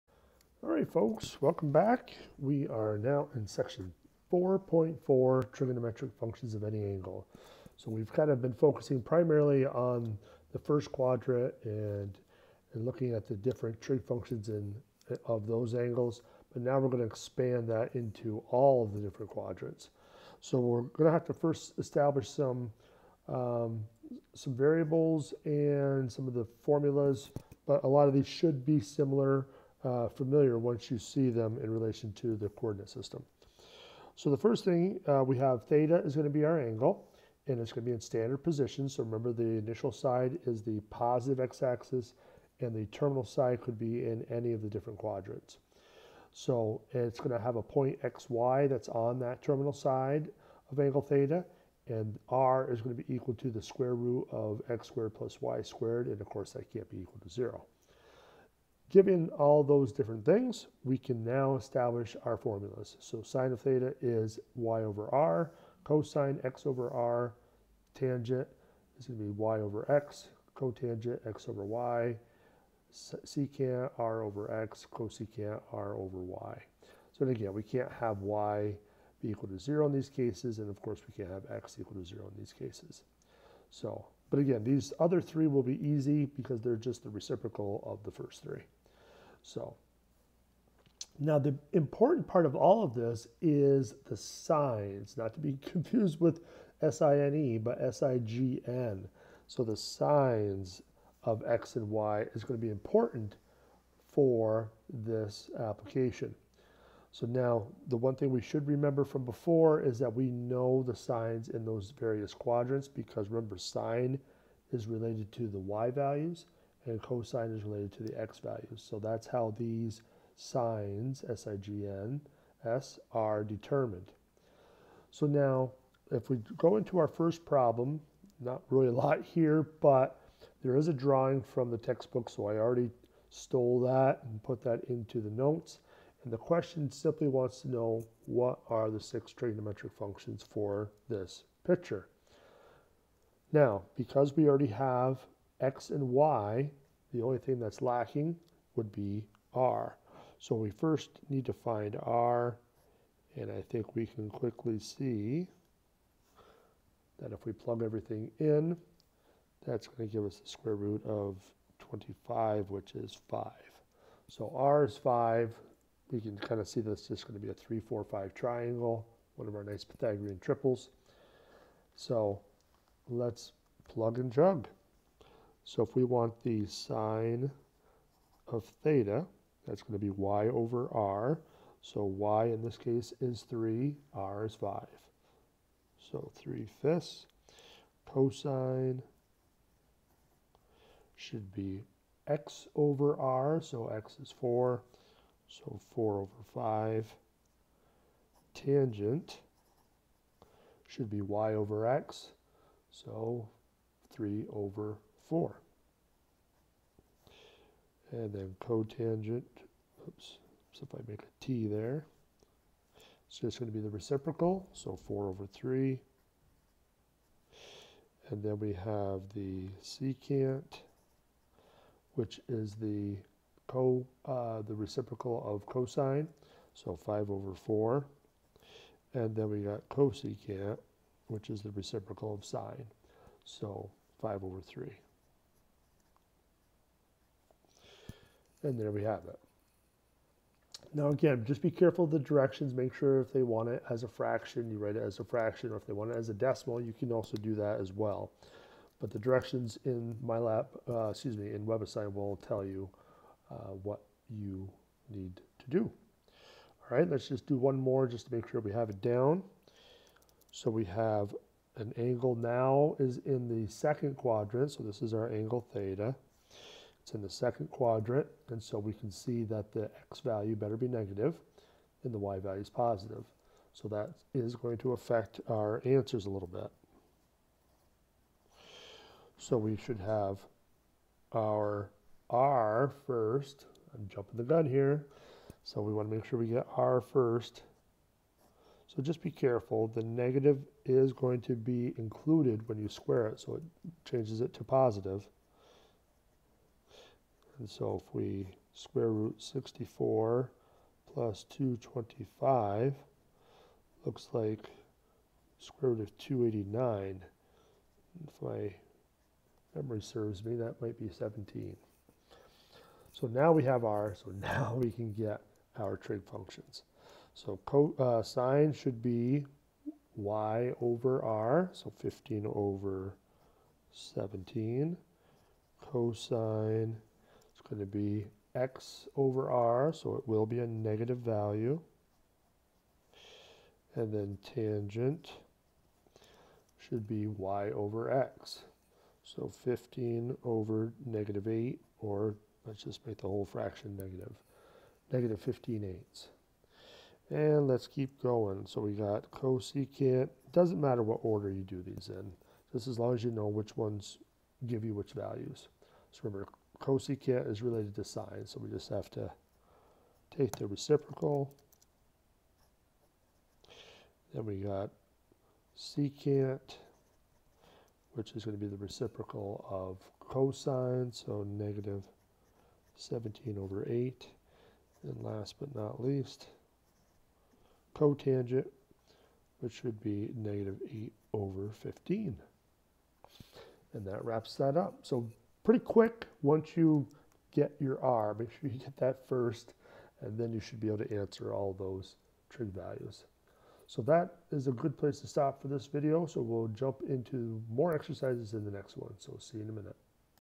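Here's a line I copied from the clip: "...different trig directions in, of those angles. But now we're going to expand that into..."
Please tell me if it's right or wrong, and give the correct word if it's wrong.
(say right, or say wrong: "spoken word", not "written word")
wrong: "functions", not "directions".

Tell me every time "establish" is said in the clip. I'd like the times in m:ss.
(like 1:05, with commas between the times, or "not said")
0:21, 1:01.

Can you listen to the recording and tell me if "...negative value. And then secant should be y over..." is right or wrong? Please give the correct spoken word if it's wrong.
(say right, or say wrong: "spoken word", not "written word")
wrong: "tangent", not "secant".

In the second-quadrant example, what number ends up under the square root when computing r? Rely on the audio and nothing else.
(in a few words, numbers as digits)
289.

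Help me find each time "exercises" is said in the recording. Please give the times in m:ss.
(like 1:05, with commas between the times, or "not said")
6:37.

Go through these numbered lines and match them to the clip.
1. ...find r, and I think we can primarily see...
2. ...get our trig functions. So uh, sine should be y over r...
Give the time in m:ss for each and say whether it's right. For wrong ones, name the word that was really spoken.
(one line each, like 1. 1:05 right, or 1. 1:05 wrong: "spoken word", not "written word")
1. 2:31 wrong: "quickly", not "primarily"
2. 5:15 right.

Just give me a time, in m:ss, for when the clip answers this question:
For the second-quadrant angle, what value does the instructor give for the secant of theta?
6:11.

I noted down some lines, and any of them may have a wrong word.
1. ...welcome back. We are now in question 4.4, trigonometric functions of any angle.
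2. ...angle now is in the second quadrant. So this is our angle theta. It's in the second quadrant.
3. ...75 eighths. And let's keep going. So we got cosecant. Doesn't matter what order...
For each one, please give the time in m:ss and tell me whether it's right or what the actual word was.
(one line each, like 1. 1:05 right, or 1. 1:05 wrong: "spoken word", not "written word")
1. 0:01 wrong: "section", not "question"
2. 4:21 right
3. 5:45 wrong: "15", not "75".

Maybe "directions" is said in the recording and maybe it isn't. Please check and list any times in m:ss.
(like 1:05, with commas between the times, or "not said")
4:02, 4:09.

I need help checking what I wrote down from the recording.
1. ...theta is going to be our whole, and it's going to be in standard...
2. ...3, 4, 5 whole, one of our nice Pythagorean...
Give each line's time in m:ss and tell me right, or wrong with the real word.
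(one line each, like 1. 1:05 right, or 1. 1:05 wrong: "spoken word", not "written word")
1. 0:35 wrong: "angle", not "whole"
2. 2:47 wrong: "triangle", not "whole".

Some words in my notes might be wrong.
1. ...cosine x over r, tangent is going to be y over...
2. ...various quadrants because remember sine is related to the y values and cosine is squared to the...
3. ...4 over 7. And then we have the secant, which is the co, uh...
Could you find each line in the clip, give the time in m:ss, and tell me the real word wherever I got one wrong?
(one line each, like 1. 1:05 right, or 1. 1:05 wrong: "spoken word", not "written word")
1. 1:05 right
2. 1:51 wrong: "related", not "squared"
3. 3:34 wrong: "3", not "7".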